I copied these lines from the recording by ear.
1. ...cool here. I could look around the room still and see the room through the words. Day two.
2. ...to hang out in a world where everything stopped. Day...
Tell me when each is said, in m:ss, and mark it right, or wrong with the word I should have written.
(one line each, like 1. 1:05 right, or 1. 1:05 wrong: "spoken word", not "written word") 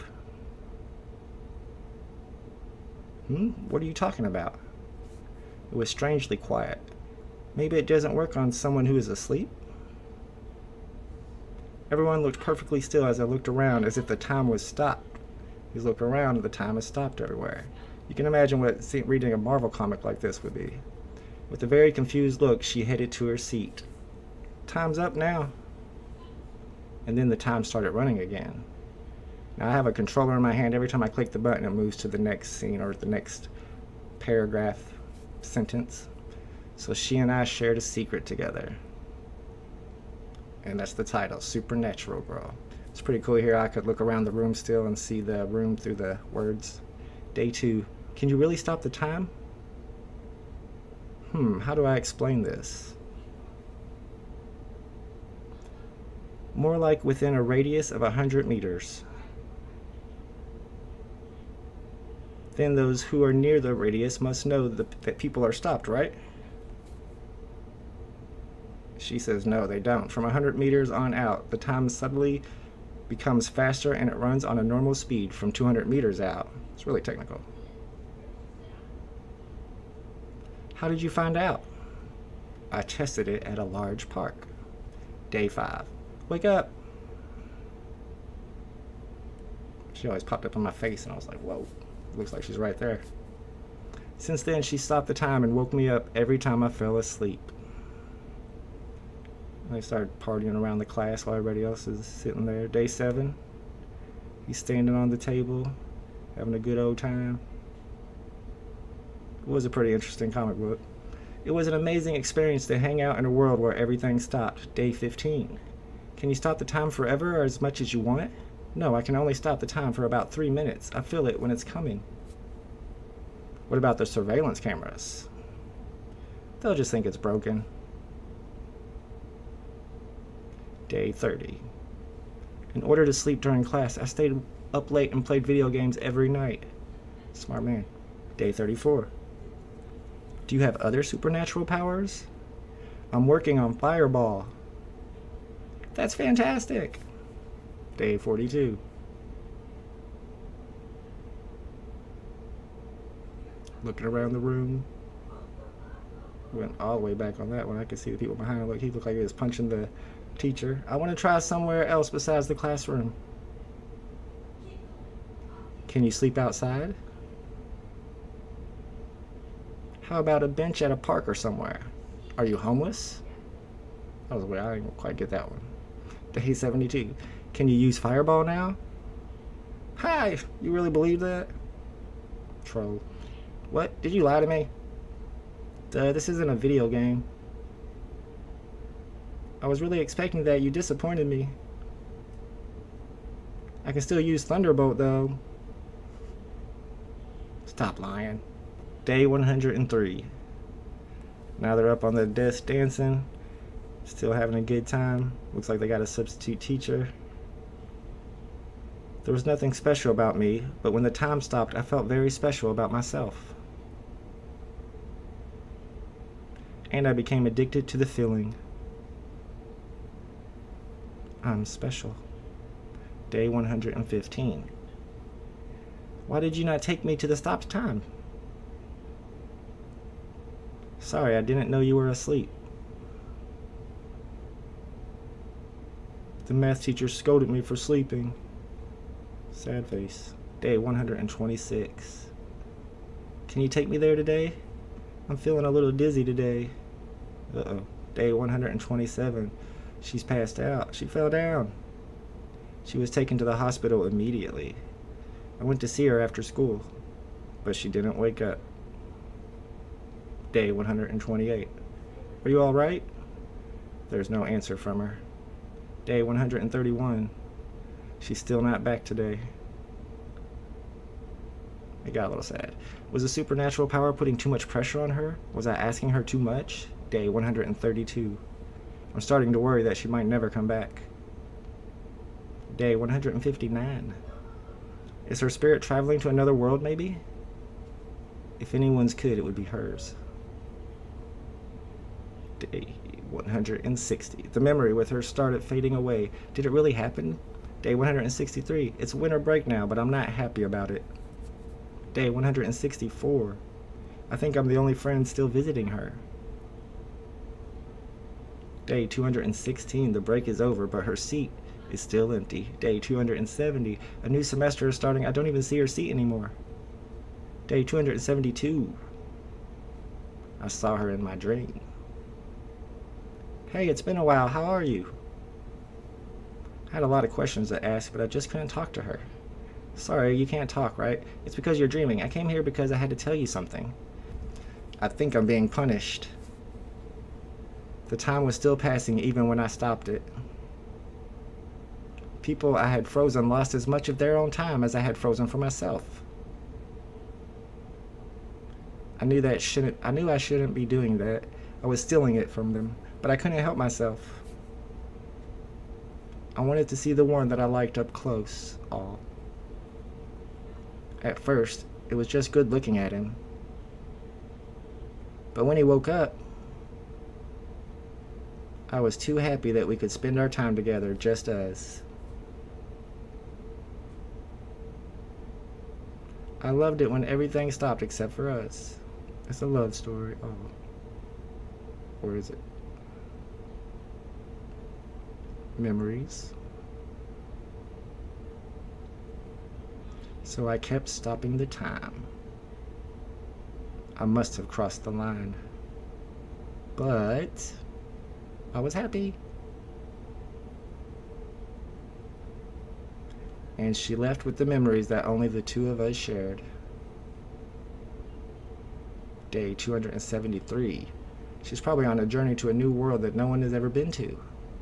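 1. 0:43 right
2. 1:52 right.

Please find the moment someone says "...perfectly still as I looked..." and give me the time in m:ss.
0:12.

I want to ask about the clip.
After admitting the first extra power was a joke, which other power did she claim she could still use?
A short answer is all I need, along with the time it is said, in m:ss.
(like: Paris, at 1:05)
Thunderbolt, at 3:14.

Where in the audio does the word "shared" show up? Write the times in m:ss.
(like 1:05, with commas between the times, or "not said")
0:37, 6:46.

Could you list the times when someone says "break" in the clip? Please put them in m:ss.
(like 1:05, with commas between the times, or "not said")
4:59, 5:10.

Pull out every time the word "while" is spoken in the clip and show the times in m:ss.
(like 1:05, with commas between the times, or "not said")
1:41, 5:24.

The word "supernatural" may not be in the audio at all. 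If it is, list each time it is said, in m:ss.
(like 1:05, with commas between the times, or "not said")
0:41, 2:21, 4:33.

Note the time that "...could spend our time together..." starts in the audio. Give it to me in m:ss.
6:09.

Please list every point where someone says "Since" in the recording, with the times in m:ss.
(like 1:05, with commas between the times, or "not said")
1:34.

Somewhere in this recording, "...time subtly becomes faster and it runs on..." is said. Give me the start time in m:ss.
1:11.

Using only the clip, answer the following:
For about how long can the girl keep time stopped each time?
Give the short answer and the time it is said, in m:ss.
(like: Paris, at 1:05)
three minutes, at 2:00.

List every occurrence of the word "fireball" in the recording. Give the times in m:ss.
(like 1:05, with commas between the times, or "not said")
2:23, 2:57.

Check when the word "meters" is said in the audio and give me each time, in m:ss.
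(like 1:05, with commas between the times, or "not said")
0:58, 1:10, 1:15.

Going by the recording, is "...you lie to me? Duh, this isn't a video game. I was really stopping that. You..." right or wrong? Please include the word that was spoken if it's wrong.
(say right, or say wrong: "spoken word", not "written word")
wrong: "expecting", not "stopping".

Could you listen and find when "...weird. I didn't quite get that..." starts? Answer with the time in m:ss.
2:54.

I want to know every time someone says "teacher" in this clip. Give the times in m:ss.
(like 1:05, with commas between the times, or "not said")
2:40, 3:26, 3:56.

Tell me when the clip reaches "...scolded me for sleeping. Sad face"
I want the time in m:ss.
3:57.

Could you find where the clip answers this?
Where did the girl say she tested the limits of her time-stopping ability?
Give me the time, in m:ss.
1:23.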